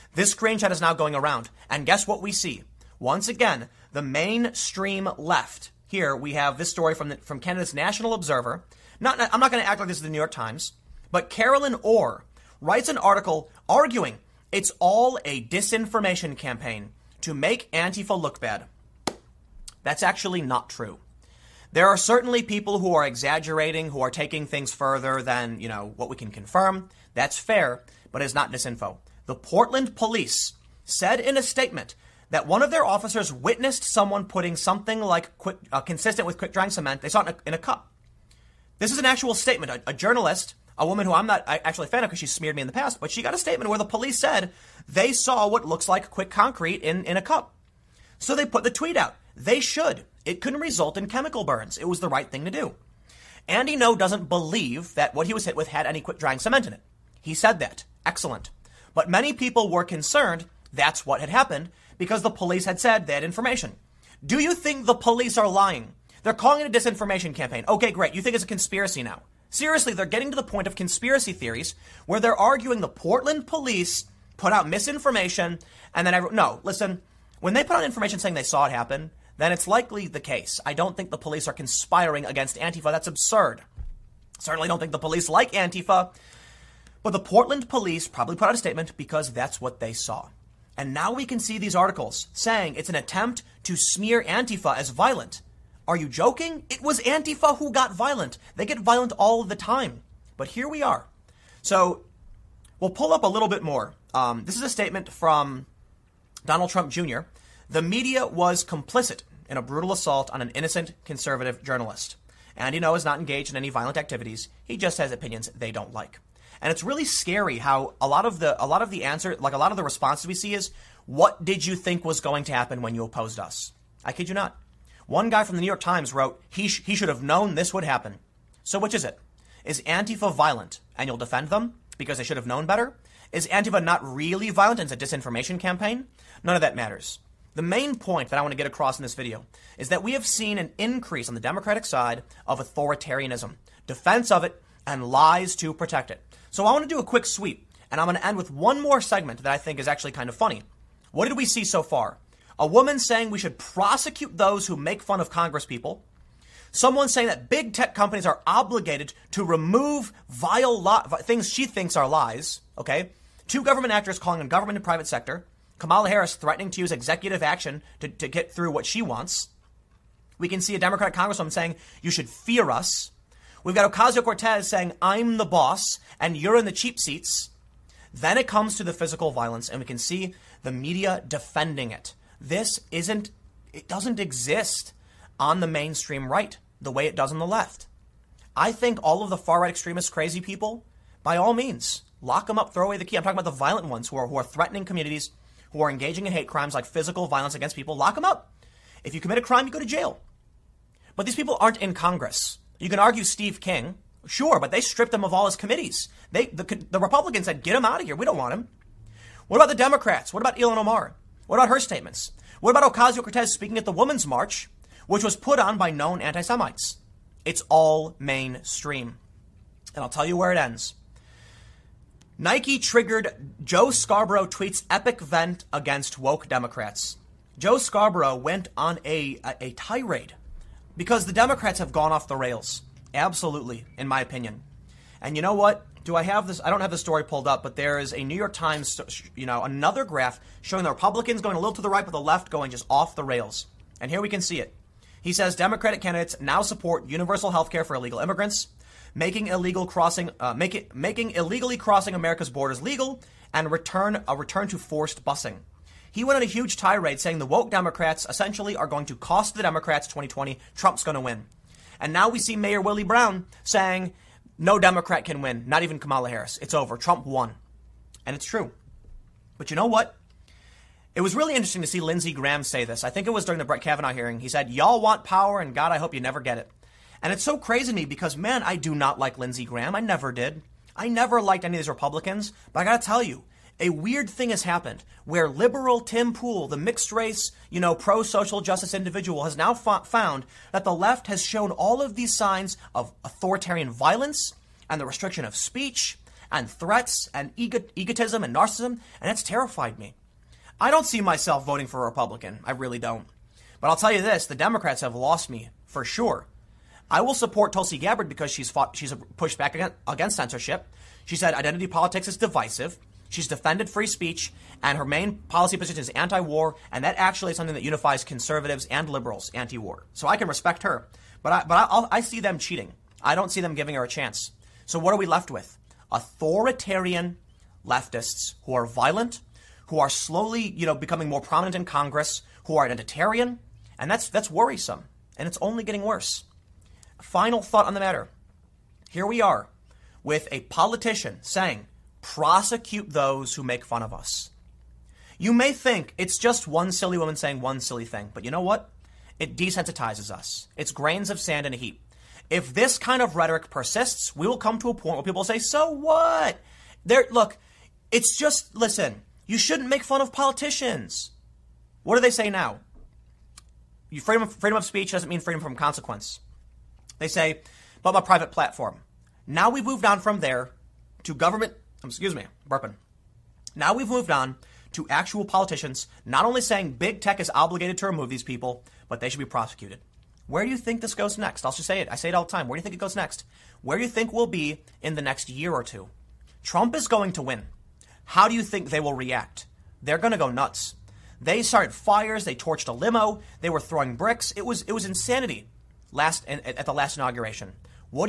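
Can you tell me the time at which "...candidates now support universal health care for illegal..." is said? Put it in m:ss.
4:06.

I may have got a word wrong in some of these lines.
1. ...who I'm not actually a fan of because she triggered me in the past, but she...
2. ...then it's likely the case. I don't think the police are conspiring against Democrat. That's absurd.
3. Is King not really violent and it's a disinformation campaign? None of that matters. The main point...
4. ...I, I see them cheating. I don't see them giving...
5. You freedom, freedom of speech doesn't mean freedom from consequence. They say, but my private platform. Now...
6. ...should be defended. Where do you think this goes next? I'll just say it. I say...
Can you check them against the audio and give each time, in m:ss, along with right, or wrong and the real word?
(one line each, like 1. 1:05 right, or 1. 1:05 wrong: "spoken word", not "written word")
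1. 0:41 wrong: "smeared", not "triggered"
2. 1:19 wrong: "Antifa", not "Democrat"
3. 2:13 wrong: "Antifa", not "King"
4. 5:21 right
5. 6:04 right
6. 6:19 wrong: "prosecuted", not "defended".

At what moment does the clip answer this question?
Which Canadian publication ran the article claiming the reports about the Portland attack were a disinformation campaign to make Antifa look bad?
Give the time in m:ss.
0:07.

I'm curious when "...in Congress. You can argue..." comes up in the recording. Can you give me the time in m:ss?
3:21.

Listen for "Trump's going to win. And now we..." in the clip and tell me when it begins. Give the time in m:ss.
4:20.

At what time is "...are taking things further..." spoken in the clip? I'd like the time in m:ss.
0:24.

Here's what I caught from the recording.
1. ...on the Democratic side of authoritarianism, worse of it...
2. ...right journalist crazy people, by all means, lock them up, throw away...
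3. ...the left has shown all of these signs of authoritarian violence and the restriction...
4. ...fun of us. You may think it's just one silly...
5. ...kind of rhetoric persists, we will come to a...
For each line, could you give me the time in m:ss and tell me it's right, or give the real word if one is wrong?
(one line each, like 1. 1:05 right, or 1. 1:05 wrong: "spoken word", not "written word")
1. 2:21 wrong: "defense", not "worse"
2. 3:09 wrong: "extremist", not "journalist"
3. 4:50 right
4. 5:43 right
5. 5:52 right.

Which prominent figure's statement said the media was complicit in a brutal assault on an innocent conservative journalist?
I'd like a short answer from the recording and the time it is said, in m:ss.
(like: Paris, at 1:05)
Donald Trump Jr., at 1:46.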